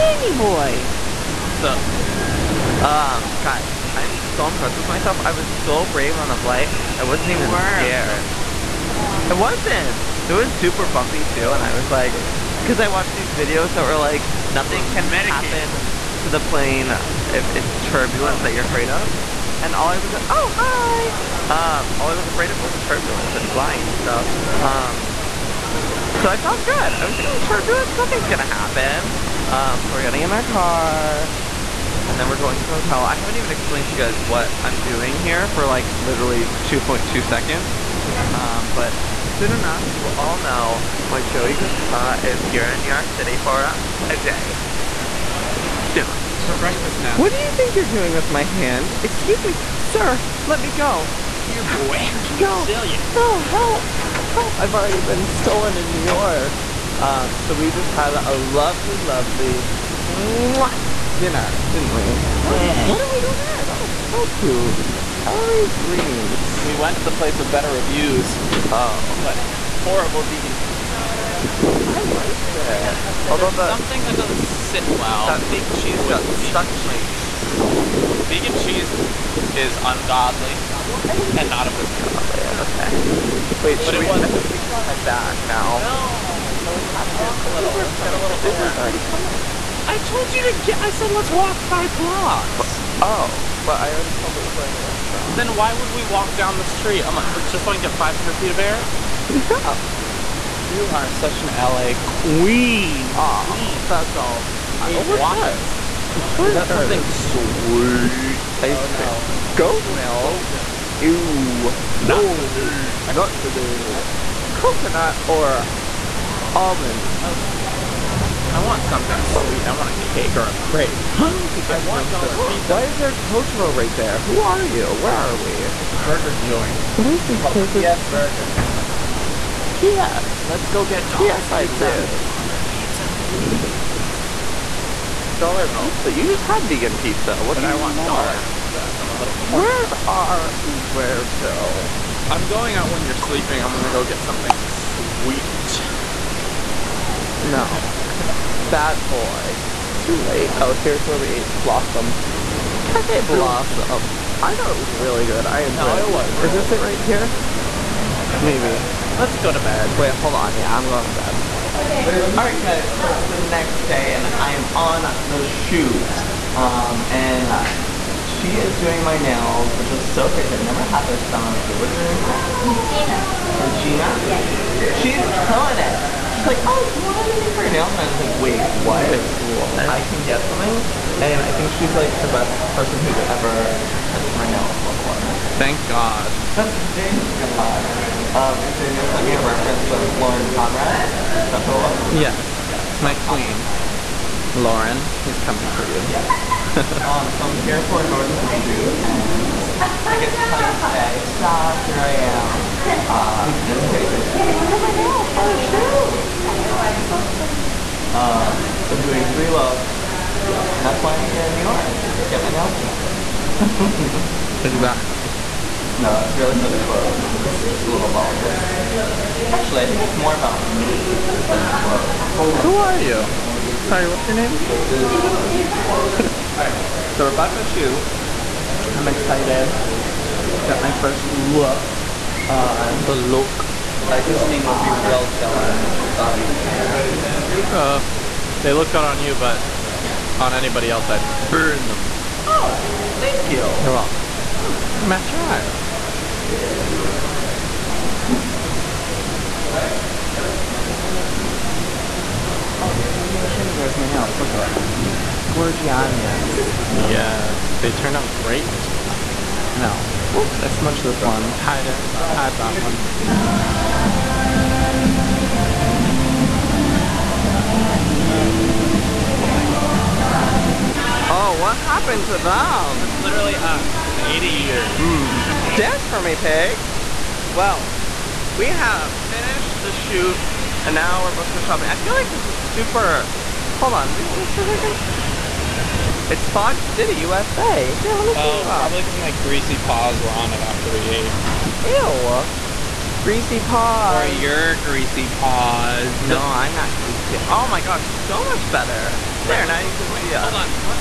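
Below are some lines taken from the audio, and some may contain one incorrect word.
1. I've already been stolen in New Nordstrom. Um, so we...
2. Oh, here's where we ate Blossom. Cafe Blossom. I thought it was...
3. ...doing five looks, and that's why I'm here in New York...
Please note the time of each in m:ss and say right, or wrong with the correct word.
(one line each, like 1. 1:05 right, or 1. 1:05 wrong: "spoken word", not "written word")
1. 0:54 wrong: "York", not "Nordstrom"
2. 2:30 right
3. 3:29 wrong: "three", not "five".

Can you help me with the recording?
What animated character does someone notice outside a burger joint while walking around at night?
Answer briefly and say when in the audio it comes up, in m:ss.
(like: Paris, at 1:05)
Totoro, at 2:03.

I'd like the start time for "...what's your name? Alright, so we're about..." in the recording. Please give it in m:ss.
3:44.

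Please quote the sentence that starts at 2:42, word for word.
Alright guys, so it's the next day and I'm on the shoot.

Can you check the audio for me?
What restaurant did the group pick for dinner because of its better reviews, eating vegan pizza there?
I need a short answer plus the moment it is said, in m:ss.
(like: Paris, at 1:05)
Ellary's Greens, at 1:05.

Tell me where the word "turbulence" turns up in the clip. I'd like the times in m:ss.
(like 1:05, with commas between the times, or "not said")
0:17, 0:22, 0:27.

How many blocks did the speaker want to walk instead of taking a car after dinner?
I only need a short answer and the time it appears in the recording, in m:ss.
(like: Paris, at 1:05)
5, at 1:31.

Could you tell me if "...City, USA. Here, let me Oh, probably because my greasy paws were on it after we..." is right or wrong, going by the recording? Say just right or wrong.
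right.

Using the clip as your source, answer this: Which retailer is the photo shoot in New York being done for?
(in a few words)
Nordstrom.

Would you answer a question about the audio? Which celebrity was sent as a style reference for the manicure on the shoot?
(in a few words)
Lauren Conrad.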